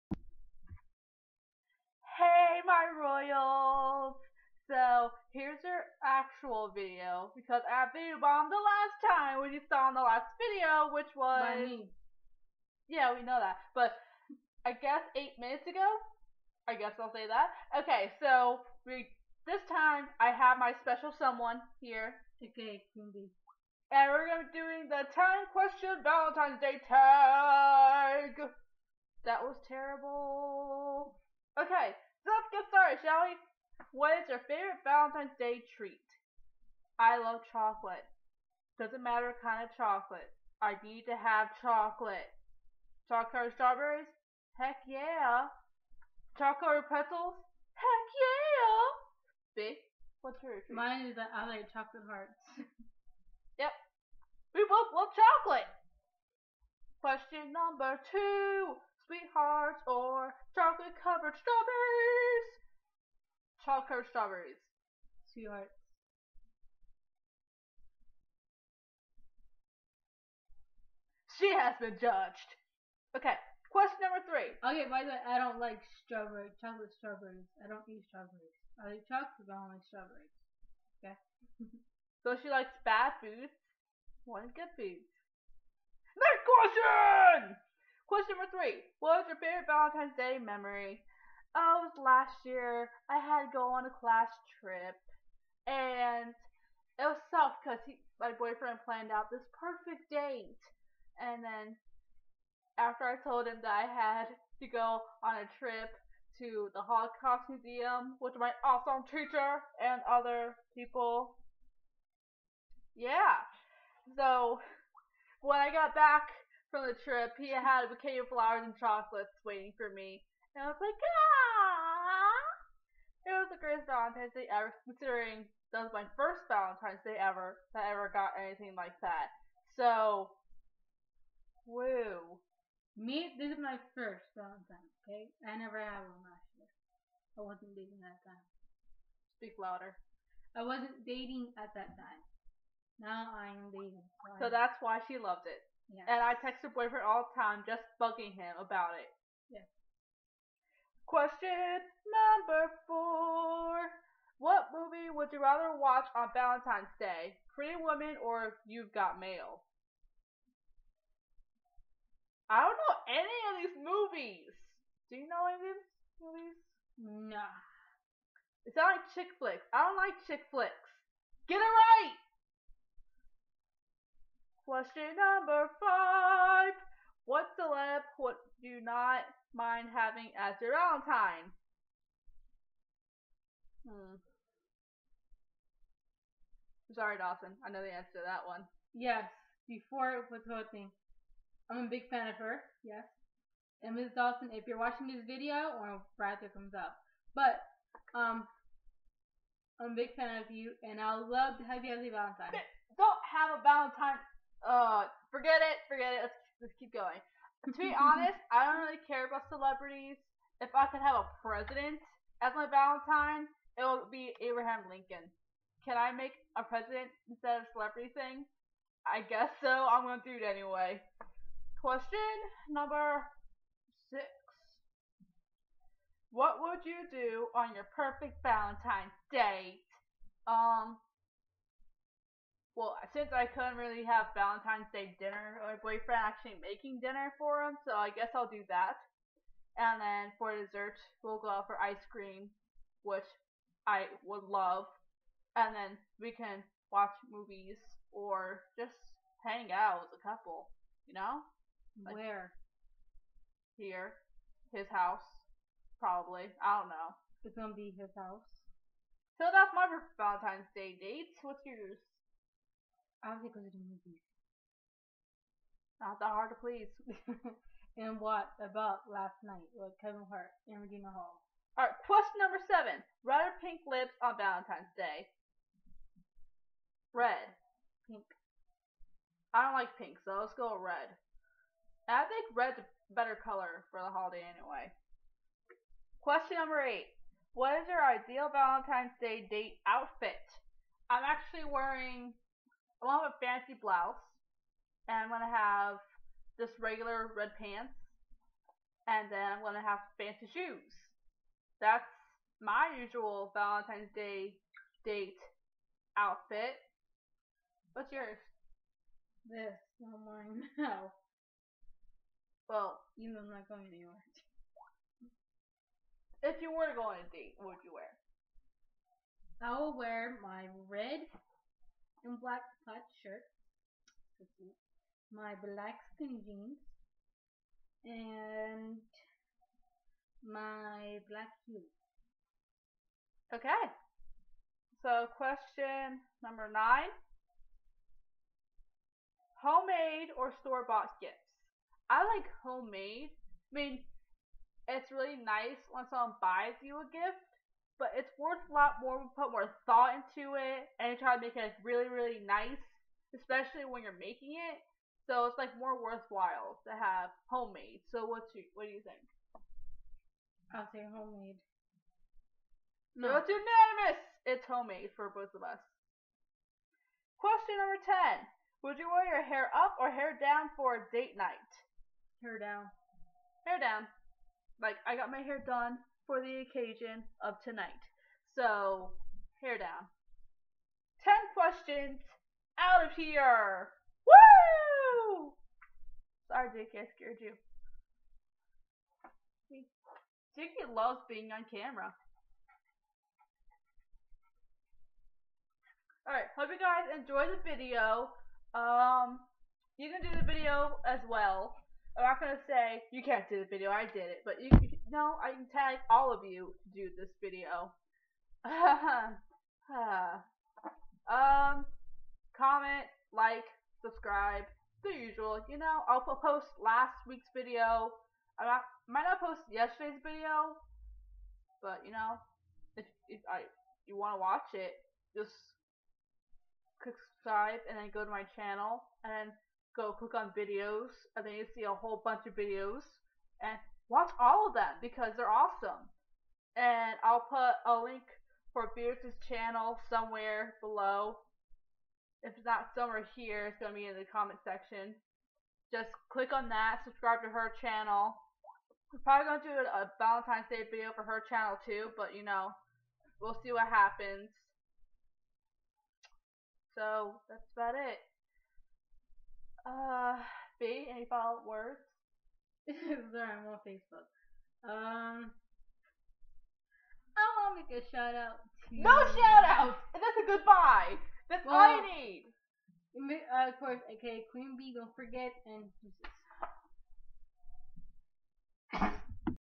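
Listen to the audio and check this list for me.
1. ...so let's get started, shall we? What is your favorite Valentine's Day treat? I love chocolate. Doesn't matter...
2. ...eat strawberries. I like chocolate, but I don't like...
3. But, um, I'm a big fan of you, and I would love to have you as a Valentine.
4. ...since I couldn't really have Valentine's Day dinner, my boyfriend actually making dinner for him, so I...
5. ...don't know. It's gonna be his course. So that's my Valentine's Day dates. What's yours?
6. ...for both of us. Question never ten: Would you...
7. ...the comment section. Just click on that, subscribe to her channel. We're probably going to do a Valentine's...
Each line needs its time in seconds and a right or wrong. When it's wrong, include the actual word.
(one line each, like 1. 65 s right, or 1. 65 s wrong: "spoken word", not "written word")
1. 32 s right
2. 77 s right
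3. 197 s right
4. 233 s right
5. 256 s wrong: "house", not "course"
6. 365 s wrong: "number", not "never"
7. 444 s right.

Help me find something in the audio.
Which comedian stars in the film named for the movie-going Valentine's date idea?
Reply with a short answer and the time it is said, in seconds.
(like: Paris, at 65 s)
Kevin Hart, at 270 s.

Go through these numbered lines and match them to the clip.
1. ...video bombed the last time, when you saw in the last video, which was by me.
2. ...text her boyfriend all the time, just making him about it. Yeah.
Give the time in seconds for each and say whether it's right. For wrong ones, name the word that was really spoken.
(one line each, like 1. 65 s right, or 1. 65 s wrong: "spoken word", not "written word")
1. 7 s right
2. 146 s wrong: "bugging", not "making".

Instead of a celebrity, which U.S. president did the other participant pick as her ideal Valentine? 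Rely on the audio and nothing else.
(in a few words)
Abraham Lincoln.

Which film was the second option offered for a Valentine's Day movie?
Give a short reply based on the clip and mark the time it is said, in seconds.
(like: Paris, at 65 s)
You've Got Mail, at 158 s.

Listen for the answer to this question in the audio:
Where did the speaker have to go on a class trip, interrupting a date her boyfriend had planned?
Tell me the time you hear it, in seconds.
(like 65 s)
106 s.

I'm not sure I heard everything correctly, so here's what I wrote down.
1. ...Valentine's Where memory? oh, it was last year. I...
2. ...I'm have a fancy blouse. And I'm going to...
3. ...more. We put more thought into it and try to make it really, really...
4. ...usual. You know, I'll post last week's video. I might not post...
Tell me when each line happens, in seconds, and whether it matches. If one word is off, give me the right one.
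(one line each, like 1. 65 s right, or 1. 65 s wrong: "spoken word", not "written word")
1. 89 s wrong: "Day", not "Where"
2. 293 s right
3. 348 s right
4. 415 s right.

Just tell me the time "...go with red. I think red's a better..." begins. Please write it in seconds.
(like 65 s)
280 s.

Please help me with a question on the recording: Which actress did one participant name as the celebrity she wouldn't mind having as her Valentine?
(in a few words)
Rosario Dawson.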